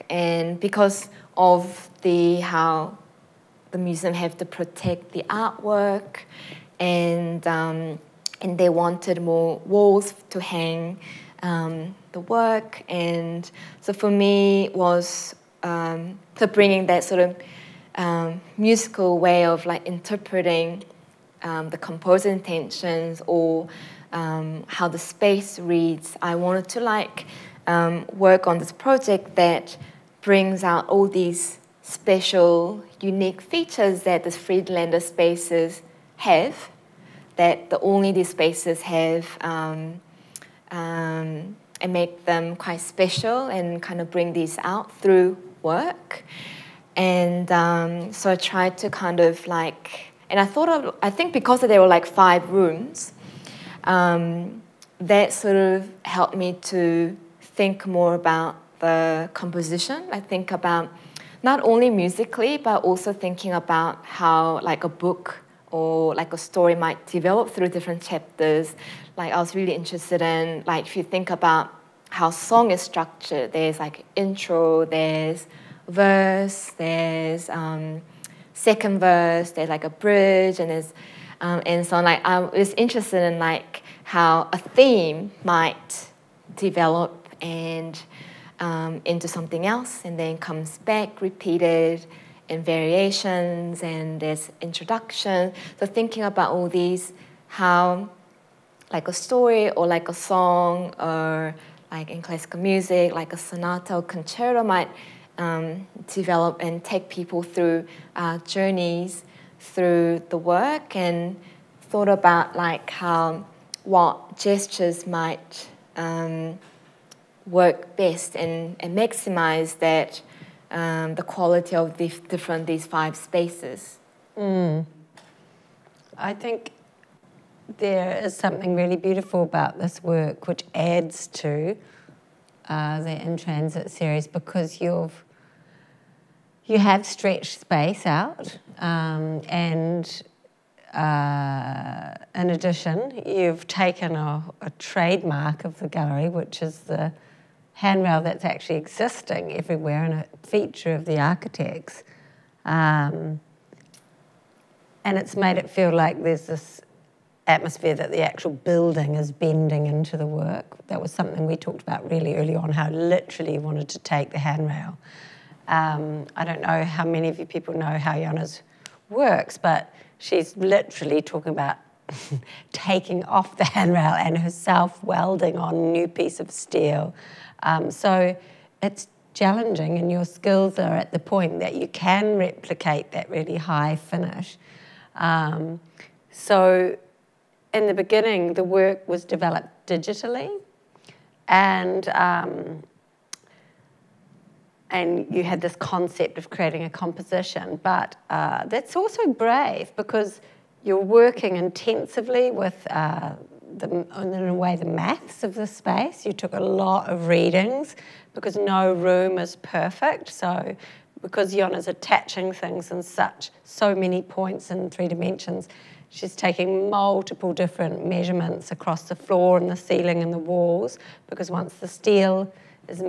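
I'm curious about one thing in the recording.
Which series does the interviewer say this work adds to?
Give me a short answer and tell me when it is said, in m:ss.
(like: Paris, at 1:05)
In Transit, at 2:13.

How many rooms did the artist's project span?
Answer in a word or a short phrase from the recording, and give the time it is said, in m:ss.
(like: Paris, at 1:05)
5, at 0:52.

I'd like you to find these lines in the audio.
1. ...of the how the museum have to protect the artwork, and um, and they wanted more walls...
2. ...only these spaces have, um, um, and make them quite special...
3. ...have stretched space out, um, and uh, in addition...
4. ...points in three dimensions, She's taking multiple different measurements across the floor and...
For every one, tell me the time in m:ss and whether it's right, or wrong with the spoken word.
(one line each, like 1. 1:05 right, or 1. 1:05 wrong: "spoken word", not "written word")
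1. 0:01 right
2. 0:37 right
3. 2:16 right
4. 3:34 right.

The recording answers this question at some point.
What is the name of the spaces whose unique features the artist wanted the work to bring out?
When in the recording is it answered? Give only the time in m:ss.
0:34.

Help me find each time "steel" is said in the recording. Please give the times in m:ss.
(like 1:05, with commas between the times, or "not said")
2:56, 3:41.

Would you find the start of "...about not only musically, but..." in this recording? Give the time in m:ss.
1:00.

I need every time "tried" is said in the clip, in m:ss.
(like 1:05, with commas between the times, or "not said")
0:48.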